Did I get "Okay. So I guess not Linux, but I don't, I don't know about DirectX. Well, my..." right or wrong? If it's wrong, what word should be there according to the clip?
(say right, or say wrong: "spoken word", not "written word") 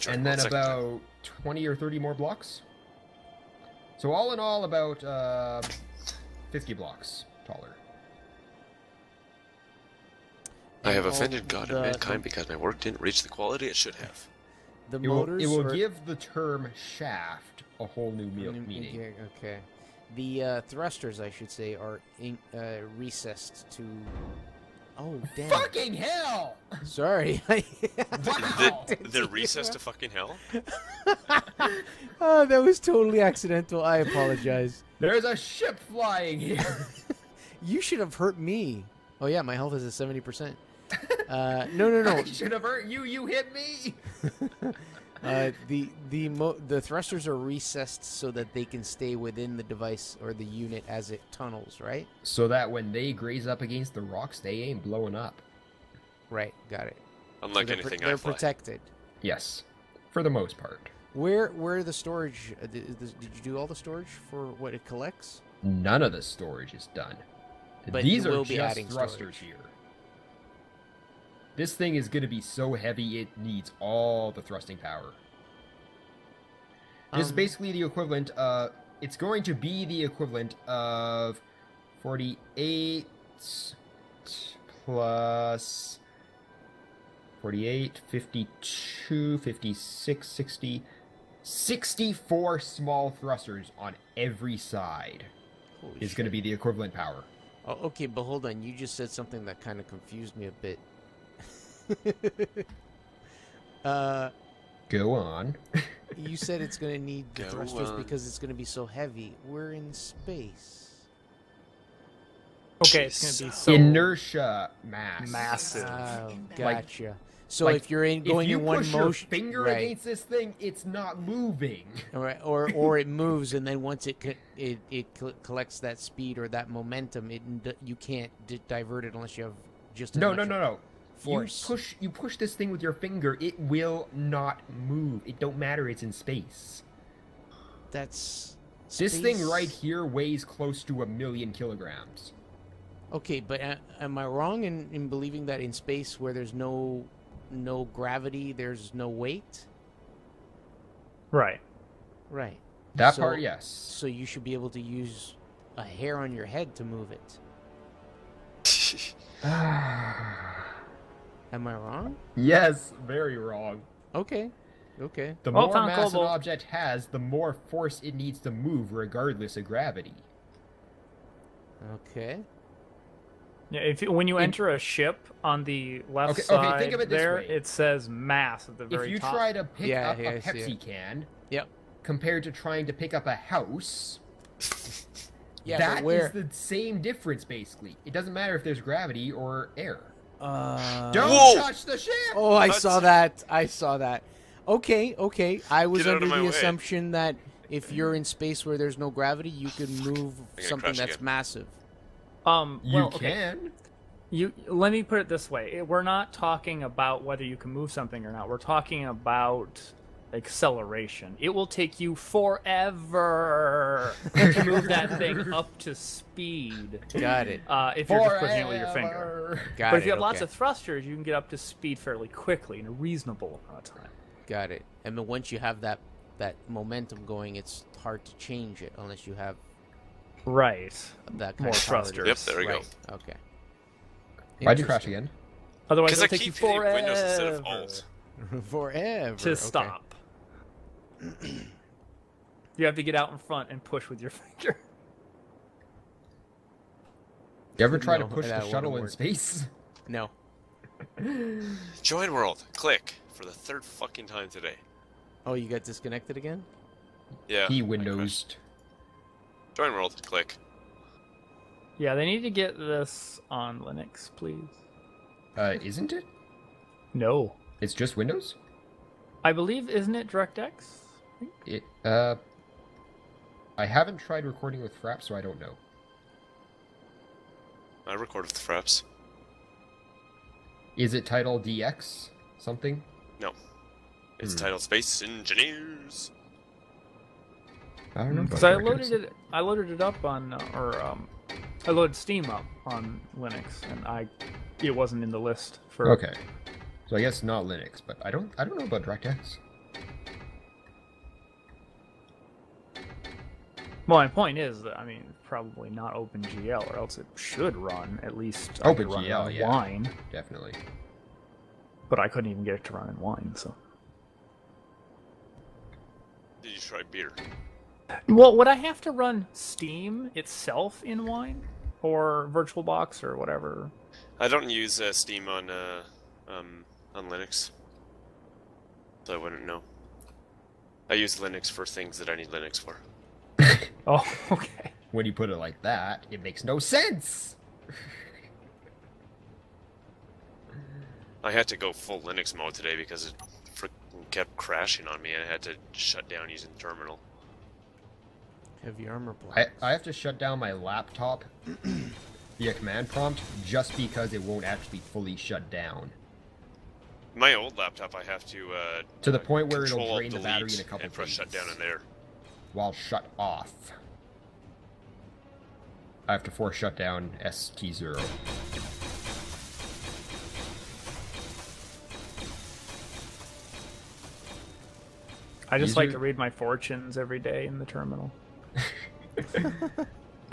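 right.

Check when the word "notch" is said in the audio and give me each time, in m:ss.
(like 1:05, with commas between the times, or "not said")
not said.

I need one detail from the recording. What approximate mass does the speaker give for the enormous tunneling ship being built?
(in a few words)
a million kilograms.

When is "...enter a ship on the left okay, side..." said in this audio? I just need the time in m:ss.
2:54.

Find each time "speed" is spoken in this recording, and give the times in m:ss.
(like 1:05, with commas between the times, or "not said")
2:05, 3:35, 3:41.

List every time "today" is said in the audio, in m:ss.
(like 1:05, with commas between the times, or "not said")
4:14, 5:42.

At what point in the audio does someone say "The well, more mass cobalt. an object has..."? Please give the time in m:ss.
2:45.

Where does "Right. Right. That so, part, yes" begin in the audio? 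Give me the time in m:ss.
2:31.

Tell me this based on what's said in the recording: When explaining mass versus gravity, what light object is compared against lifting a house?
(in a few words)
Pepsi can.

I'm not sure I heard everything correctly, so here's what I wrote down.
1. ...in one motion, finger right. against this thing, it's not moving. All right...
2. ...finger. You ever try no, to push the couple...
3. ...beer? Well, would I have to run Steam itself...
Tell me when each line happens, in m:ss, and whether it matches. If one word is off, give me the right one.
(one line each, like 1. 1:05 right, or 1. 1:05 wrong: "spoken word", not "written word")
1. 1:58 right
2. 4:04 wrong: "shuttle", not "couple"
3. 5:17 right.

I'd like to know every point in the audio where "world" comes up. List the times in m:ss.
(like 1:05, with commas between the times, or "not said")
4:12, 4:19.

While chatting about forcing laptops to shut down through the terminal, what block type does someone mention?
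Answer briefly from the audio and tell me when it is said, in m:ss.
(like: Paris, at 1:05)
Heavy armor black, at 5:48.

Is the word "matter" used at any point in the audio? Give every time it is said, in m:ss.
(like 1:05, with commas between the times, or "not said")
2:15, 3:08.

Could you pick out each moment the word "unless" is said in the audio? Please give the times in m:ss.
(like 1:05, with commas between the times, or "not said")
2:09, 3:48.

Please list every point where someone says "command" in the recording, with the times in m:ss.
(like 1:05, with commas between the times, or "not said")
5:52.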